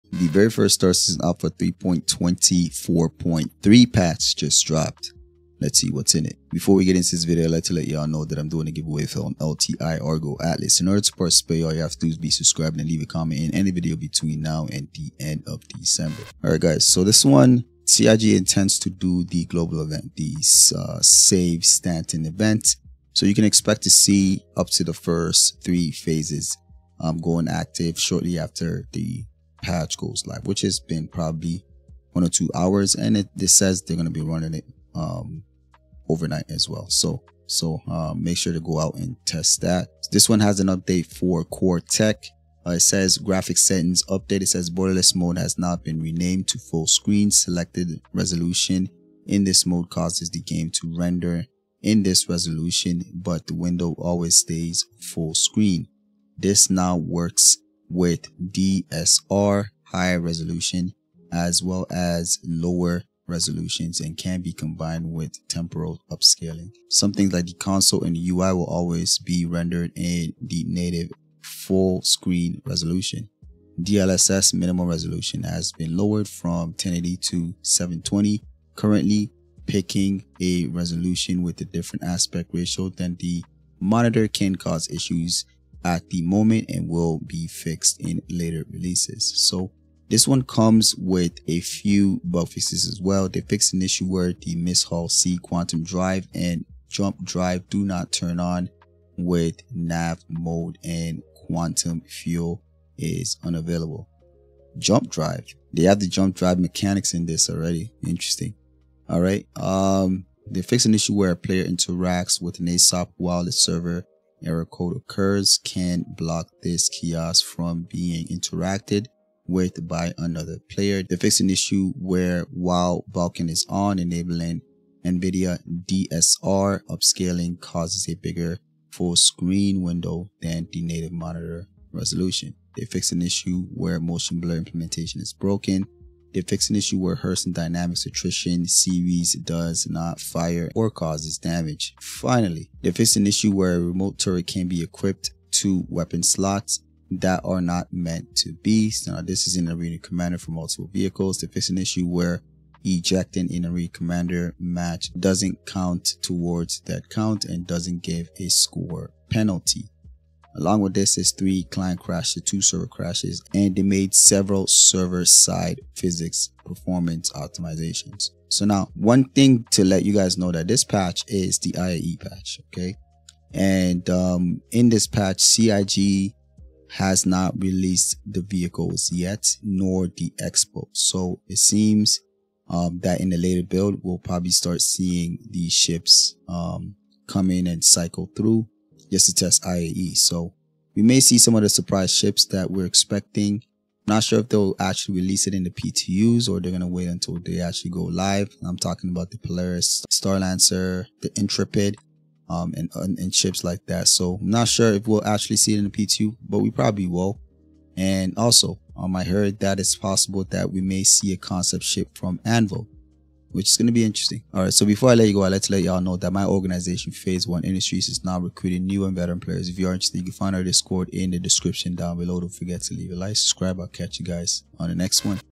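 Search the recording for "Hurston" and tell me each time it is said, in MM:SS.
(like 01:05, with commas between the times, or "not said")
02:17.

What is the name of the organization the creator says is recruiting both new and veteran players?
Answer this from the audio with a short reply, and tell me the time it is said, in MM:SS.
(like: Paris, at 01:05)
Phase One Industries, at 03:37.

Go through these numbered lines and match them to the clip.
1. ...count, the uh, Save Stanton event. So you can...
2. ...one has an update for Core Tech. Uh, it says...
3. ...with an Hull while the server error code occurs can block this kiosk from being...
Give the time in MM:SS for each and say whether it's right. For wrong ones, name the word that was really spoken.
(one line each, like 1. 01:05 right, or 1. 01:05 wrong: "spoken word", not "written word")
1. 00:19 wrong: "event", not "count"
2. 00:40 right
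3. 01:52 wrong: "ASOP", not "Hull".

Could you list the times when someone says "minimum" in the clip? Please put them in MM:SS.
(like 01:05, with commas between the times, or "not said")
01:14.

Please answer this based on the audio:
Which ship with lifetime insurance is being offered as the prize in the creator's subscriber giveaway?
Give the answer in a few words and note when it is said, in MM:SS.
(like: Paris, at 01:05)
Argo Atlas, at 00:10.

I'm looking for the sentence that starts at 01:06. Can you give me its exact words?
Something like the console and the UI will always be rendered in the native full screen resolution.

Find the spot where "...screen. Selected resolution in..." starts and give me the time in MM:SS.
00:46.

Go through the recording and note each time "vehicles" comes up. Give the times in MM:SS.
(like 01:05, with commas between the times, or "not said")
02:30, 02:58.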